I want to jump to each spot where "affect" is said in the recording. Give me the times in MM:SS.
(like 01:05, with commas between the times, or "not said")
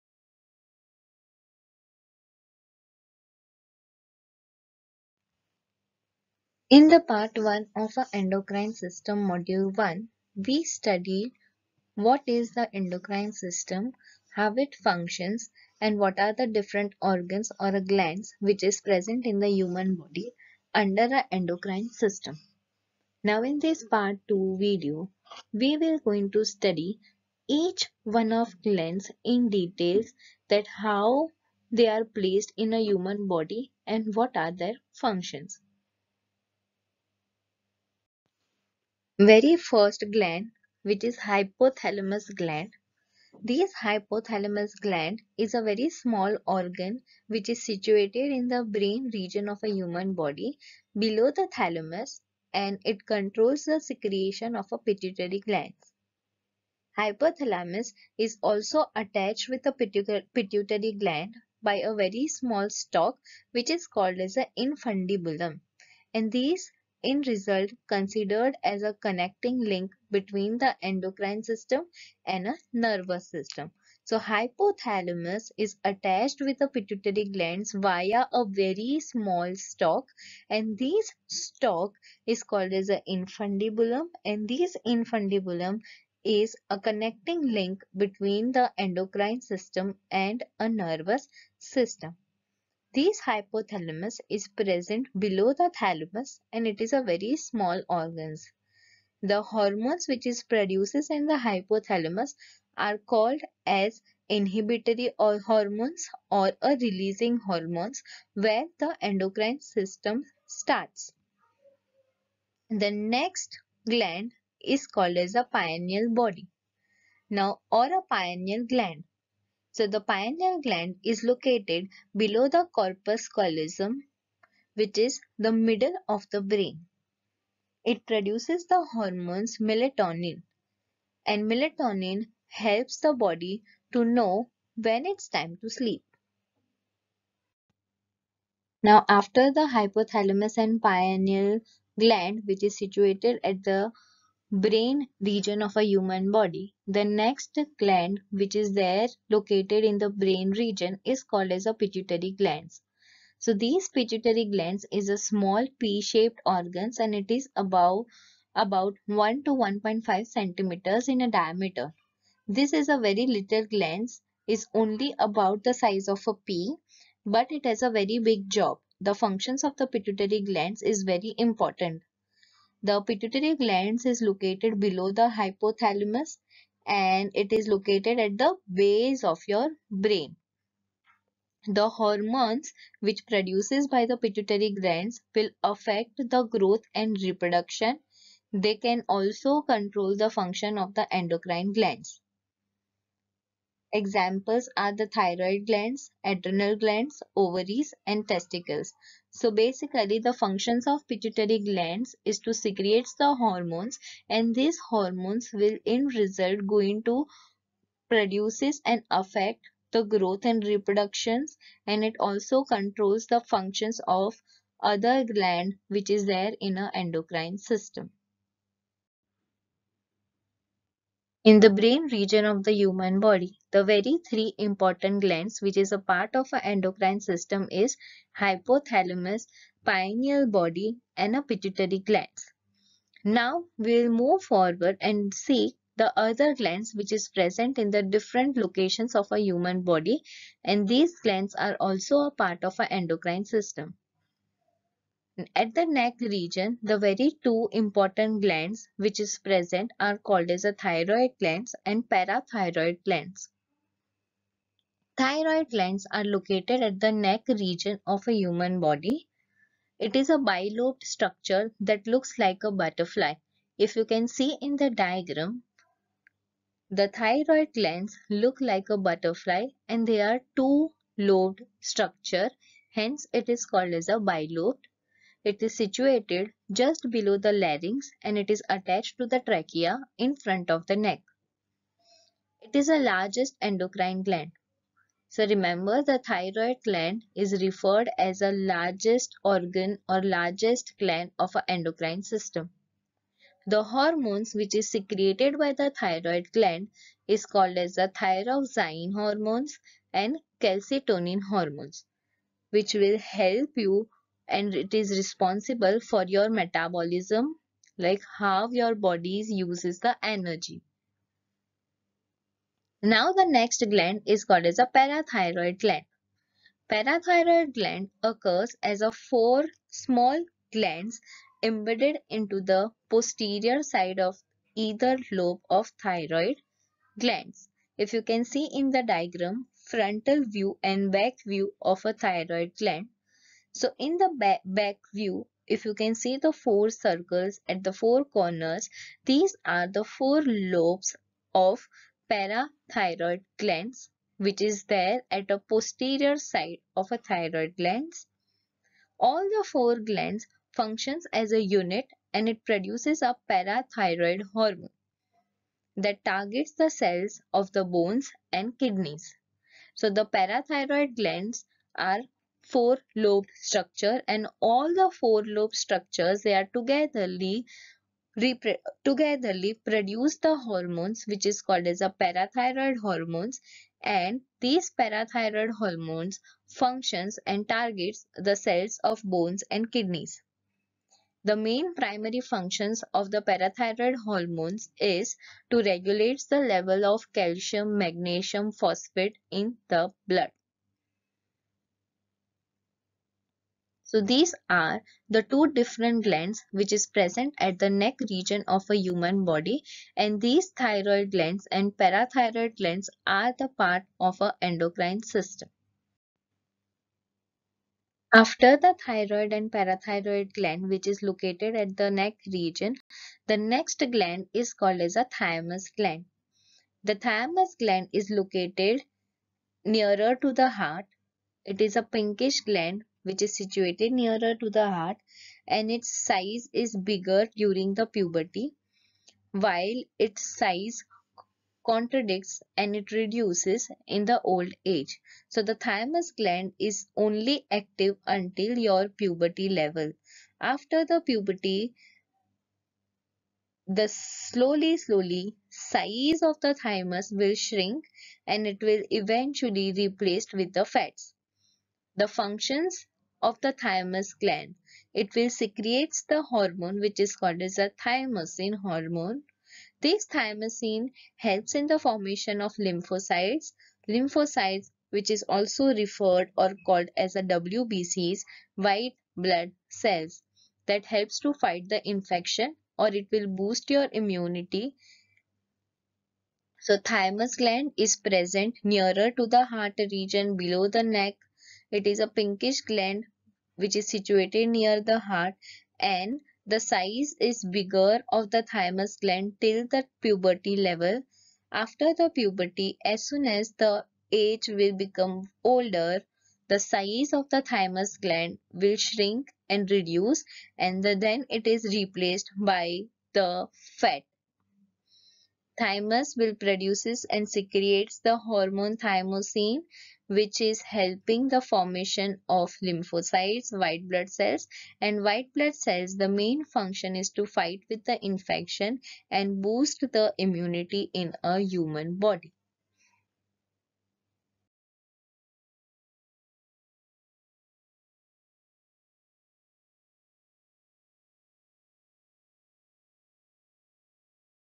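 03:05, 03:29.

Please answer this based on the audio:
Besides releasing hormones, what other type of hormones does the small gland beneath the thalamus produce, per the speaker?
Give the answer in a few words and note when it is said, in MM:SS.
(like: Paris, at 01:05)
Inhibitory, at 01:44.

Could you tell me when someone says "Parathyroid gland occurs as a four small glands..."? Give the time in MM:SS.
05:16.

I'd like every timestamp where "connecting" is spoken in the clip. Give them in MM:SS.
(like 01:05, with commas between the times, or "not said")
01:08, 01:26.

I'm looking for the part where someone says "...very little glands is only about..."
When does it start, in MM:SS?
02:42.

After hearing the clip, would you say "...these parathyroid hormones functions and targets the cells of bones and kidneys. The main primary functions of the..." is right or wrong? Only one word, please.
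right.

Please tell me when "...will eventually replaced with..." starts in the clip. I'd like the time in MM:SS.
07:28.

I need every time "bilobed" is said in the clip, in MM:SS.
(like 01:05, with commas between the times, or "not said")
04:20, 04:34.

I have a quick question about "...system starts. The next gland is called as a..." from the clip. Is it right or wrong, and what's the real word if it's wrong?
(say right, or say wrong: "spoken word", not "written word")
right.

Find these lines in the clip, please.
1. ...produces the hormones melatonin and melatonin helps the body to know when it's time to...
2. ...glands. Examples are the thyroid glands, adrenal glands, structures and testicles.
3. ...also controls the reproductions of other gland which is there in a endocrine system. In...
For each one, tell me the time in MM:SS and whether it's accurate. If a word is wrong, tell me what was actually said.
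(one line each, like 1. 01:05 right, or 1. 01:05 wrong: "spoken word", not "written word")
1. 02:08 right
2. 03:11 wrong: "ovaries", not "structures"
3. 03:32 wrong: "functions", not "reproductions".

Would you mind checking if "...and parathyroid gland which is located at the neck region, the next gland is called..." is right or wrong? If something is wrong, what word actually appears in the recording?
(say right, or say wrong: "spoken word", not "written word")
right.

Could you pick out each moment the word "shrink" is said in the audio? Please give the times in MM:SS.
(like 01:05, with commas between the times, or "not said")
07:27, 08:18.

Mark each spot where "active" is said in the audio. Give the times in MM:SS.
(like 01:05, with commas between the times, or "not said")
07:17.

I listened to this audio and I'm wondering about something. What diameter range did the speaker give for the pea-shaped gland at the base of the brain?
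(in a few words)
1 to 1.5 centimeters.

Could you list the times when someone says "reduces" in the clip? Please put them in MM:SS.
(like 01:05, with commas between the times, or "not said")
07:13, 08:19.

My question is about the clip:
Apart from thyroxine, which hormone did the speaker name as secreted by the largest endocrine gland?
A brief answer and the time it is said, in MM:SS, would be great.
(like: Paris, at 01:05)
Calcitonin, at 05:00.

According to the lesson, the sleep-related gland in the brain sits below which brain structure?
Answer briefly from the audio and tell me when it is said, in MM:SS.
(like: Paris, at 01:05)
Corpus callosum, at 02:02.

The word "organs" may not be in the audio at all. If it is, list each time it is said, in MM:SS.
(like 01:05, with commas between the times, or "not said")
00:17, 00:46, 01:37, 02:36, 04:49.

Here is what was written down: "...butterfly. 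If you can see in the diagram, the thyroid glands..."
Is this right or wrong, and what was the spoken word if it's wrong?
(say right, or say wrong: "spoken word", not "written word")
right.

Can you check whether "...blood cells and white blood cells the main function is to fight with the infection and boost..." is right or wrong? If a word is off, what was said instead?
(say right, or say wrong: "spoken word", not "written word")
right.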